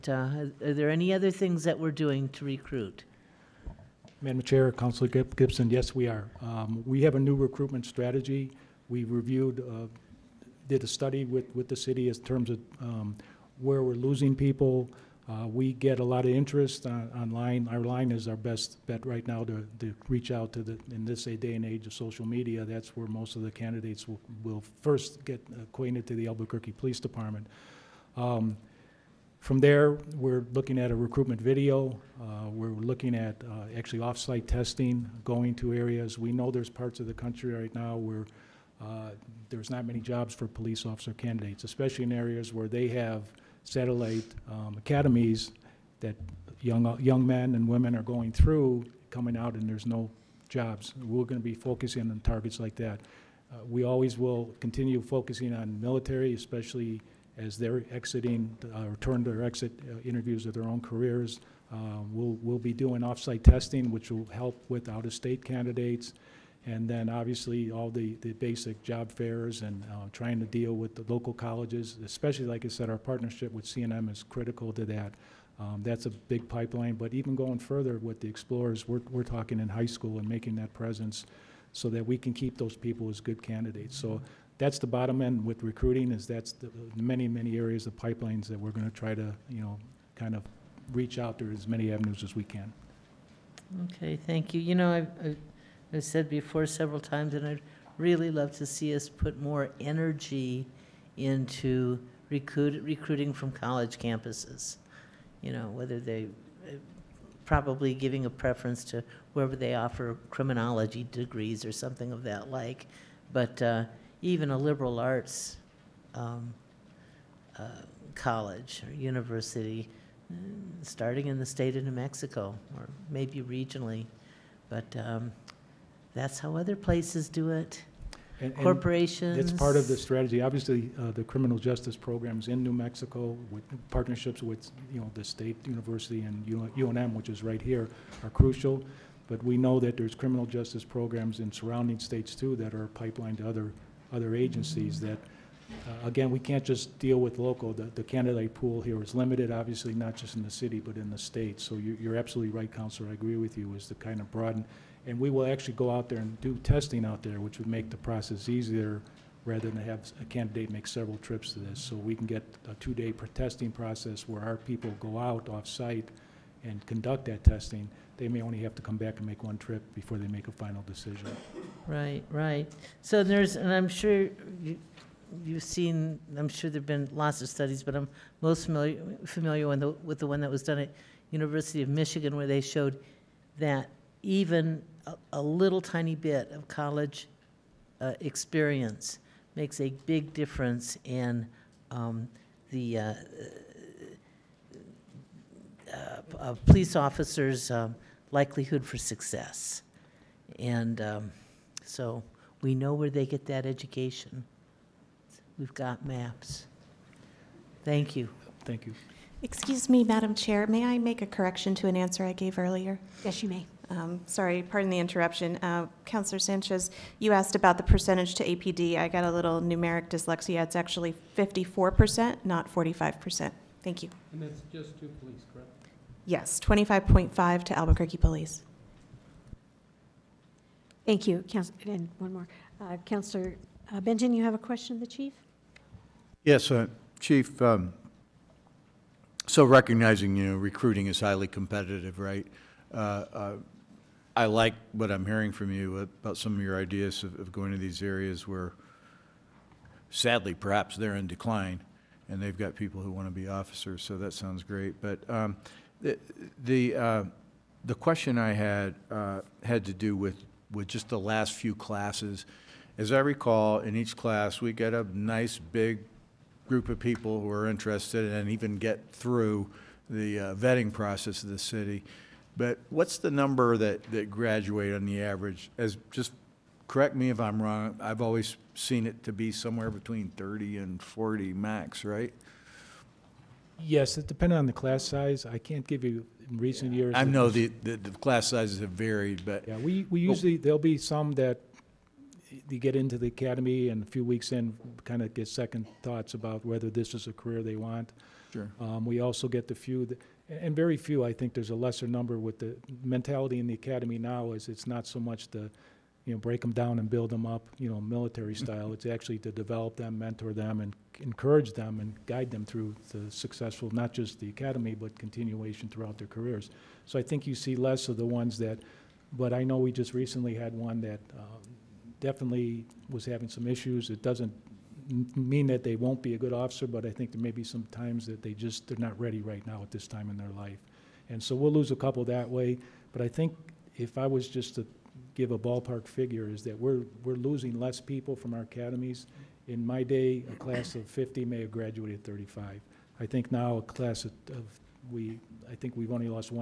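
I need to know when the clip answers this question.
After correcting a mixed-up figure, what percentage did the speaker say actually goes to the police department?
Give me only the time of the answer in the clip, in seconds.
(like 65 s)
221 s.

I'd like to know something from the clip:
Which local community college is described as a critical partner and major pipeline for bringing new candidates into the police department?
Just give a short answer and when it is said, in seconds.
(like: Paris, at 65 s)
CNM, at 73 s.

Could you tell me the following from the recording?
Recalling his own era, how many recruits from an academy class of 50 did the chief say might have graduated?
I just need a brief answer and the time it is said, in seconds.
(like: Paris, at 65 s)
35, at 342 s.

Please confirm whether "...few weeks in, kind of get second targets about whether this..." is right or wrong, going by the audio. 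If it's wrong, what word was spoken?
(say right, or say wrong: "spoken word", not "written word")
wrong: "thoughts", not "targets".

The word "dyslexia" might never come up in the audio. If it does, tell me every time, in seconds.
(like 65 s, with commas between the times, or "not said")
220 s.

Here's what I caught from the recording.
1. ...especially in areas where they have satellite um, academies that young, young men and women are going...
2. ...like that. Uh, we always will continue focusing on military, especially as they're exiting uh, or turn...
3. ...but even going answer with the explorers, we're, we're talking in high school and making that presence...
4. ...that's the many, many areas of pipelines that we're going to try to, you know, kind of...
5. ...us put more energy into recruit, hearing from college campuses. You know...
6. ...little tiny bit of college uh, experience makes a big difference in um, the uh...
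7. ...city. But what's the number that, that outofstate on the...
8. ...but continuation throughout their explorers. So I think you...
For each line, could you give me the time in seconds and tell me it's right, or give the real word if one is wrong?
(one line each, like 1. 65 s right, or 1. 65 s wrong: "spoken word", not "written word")
1. 41 s right
2. 52 s right
3. 76 s wrong: "further", not "answer"
4. 86 s right
5. 98 s wrong: "recruiting", not "hearing"
6. 185 s right
7. 271 s wrong: "graduate", not "outofstate"
8. 314 s wrong: "careers", not "explorers".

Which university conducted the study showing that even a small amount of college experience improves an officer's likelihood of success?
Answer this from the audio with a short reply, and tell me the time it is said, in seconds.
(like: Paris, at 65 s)
University of Michigan, at 181 s.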